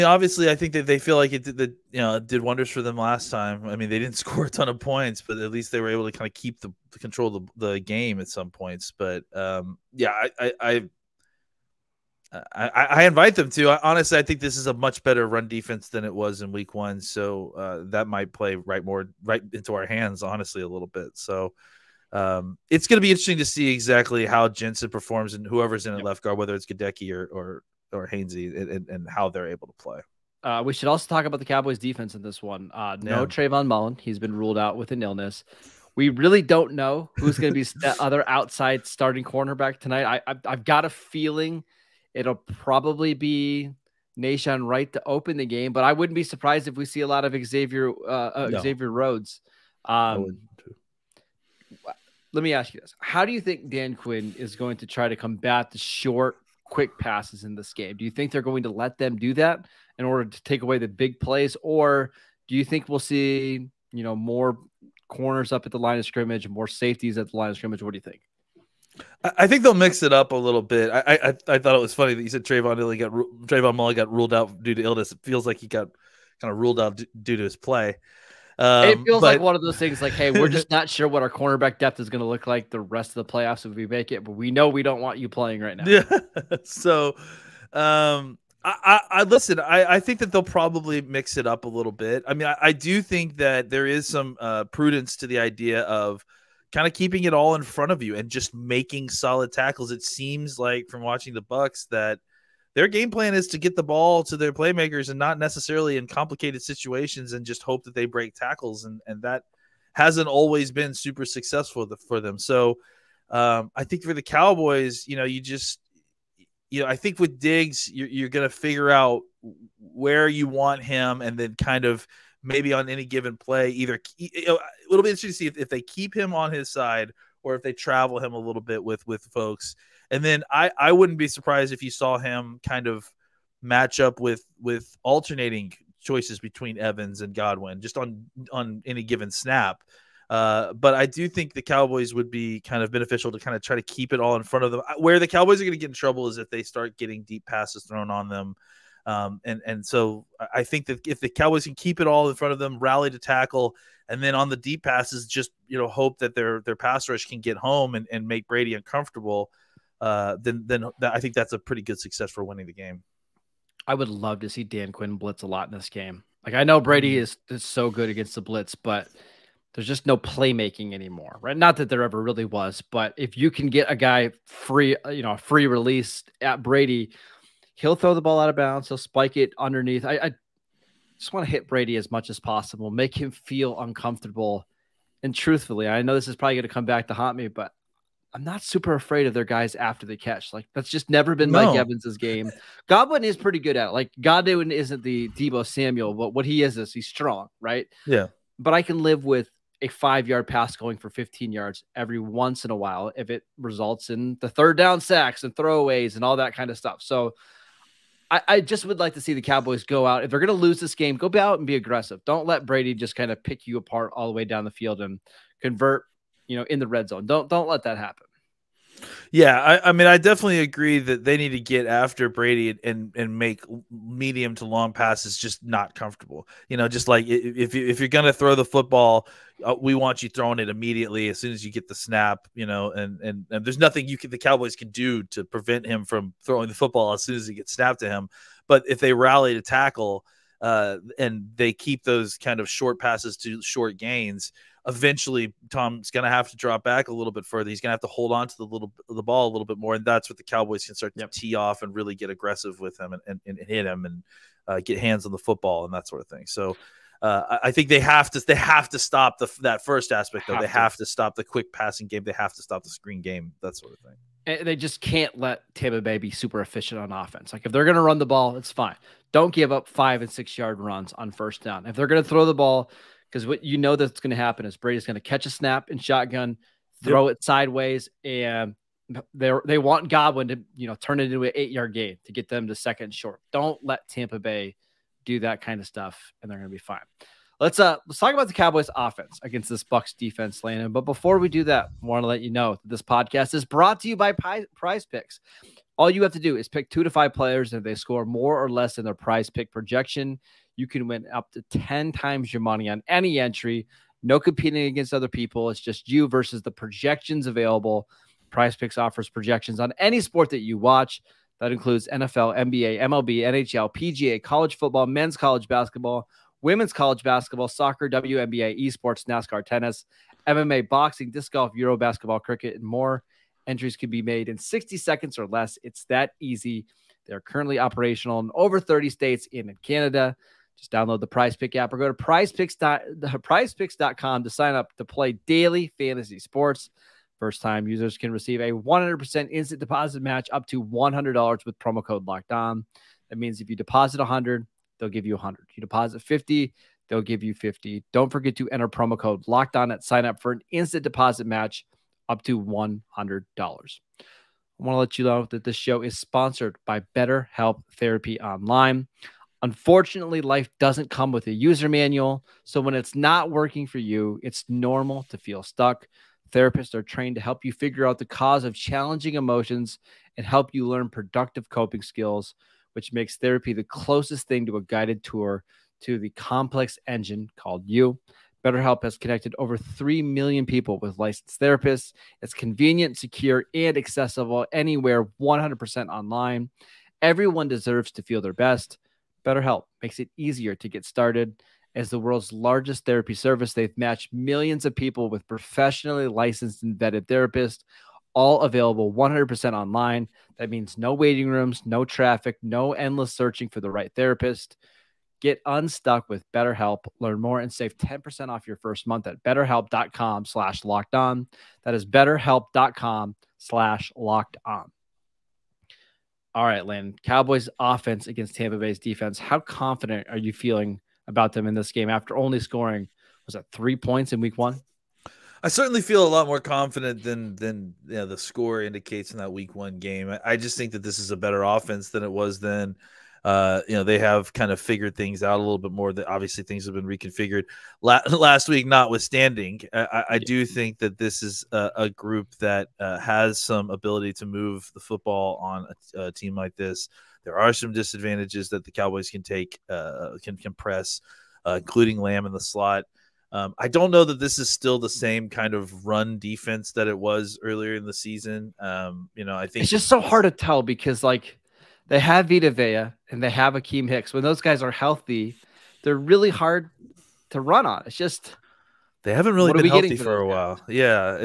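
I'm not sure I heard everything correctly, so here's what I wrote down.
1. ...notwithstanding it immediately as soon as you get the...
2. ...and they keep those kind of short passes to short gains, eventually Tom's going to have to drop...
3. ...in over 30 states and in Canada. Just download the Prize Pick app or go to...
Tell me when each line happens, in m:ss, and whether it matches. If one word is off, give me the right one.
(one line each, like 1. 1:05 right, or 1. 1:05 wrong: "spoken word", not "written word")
1. 3:50 wrong: "throwing", not "notwithstanding"
2. 4:01 right
3. 5:28 right.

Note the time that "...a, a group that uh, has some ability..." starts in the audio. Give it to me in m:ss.
7:21.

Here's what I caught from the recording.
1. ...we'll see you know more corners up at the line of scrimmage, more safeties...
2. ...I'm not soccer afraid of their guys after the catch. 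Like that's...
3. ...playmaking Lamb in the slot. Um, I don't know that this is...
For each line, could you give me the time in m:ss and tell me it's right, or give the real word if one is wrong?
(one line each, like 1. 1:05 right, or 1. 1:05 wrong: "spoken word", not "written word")
1. 1:02 right
2. 3:08 wrong: "super", not "soccer"
3. 7:31 wrong: "including", not "playmaking".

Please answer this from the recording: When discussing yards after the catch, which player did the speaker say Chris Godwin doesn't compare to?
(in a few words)
Debo Samuel.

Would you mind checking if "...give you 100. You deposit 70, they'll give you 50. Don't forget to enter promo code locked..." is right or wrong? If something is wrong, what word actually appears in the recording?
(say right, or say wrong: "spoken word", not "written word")
wrong: "50", not "70".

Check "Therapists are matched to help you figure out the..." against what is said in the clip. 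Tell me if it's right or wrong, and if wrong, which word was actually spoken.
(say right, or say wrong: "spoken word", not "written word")
wrong: "trained", not "matched".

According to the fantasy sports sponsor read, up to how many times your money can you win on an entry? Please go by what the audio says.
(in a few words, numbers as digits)
10 times.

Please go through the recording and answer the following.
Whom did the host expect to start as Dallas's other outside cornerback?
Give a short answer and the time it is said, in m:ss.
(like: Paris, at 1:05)
Nahshon Wright, at 0:44.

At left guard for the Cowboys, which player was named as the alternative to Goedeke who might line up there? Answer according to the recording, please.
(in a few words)
Hainsey.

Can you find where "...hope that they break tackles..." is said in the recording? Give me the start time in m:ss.
1:47.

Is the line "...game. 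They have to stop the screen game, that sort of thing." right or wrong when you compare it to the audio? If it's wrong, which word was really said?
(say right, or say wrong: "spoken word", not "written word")
right.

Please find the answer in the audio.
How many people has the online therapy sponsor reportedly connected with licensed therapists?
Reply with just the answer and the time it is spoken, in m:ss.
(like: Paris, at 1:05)
Over 3 million, at 6:19.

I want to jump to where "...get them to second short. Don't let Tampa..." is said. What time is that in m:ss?
4:42.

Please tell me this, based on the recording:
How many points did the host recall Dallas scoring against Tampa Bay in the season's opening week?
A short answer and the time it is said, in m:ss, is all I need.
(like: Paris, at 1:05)
3, at 7:03.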